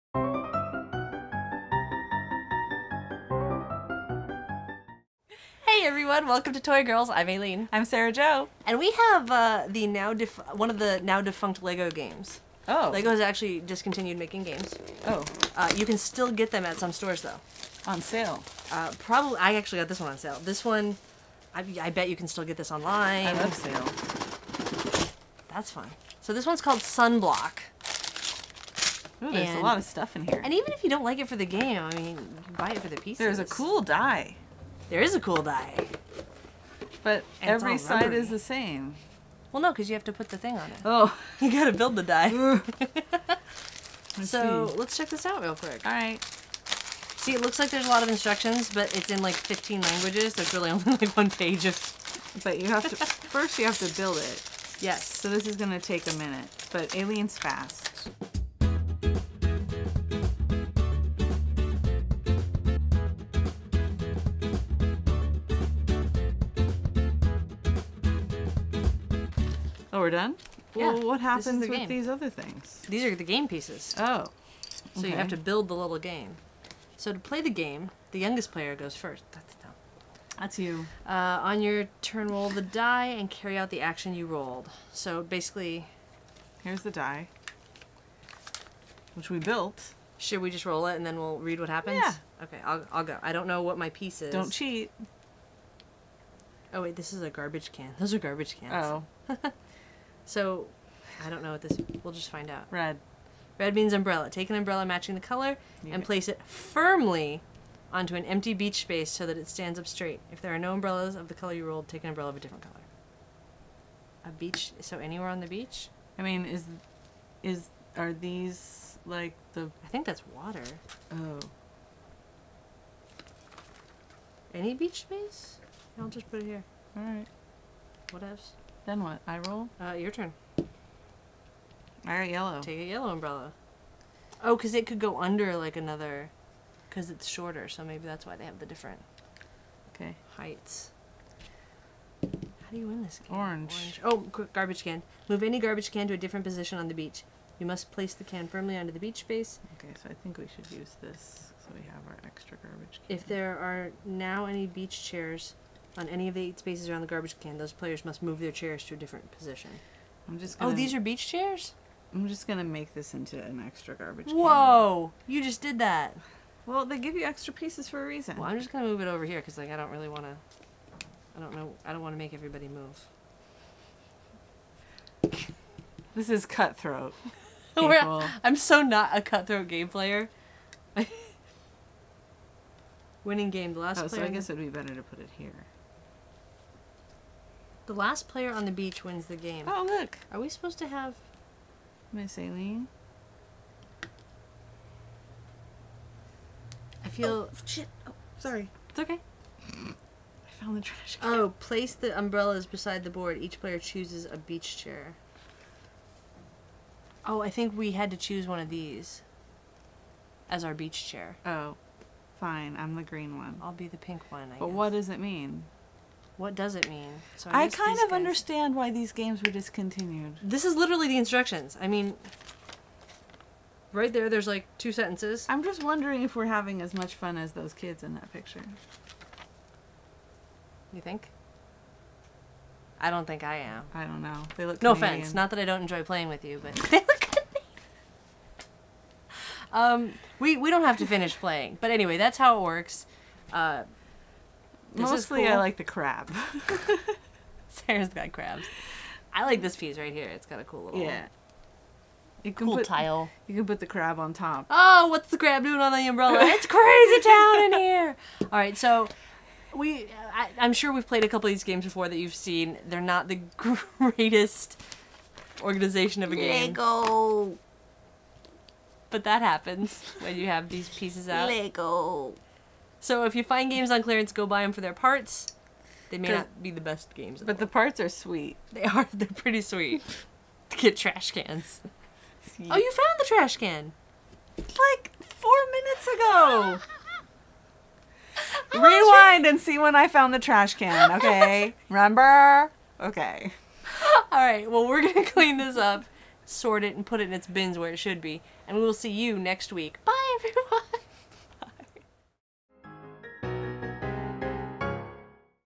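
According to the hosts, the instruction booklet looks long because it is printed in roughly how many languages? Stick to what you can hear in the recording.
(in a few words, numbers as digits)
15.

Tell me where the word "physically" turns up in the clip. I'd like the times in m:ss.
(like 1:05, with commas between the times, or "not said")
not said.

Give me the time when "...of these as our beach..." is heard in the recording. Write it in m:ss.
3:28.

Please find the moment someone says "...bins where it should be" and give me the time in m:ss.
4:57.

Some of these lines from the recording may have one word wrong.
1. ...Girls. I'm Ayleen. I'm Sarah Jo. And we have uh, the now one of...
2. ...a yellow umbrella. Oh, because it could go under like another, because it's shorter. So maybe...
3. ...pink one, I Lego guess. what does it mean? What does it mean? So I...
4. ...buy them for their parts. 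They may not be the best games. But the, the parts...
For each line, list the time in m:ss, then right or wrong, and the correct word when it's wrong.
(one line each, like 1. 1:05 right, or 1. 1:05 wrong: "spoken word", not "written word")
1. 0:06 right
2. 2:12 right
3. 3:33 wrong: "But", not "Lego"
4. 4:34 right.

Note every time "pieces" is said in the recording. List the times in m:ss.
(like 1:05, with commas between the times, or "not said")
0:33, 1:13, 1:33, 2:47, 4:09, 4:30.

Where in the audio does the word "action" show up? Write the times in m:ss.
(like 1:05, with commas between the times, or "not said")
1:23.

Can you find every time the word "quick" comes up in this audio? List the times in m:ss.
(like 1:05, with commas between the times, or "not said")
0:45, 2:24.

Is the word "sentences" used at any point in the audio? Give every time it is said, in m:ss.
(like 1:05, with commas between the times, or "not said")
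3:44.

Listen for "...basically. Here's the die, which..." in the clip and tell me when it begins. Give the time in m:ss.
1:25.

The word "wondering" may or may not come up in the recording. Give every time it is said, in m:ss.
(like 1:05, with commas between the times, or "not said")
3:45.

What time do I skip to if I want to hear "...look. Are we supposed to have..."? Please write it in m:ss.
3:09.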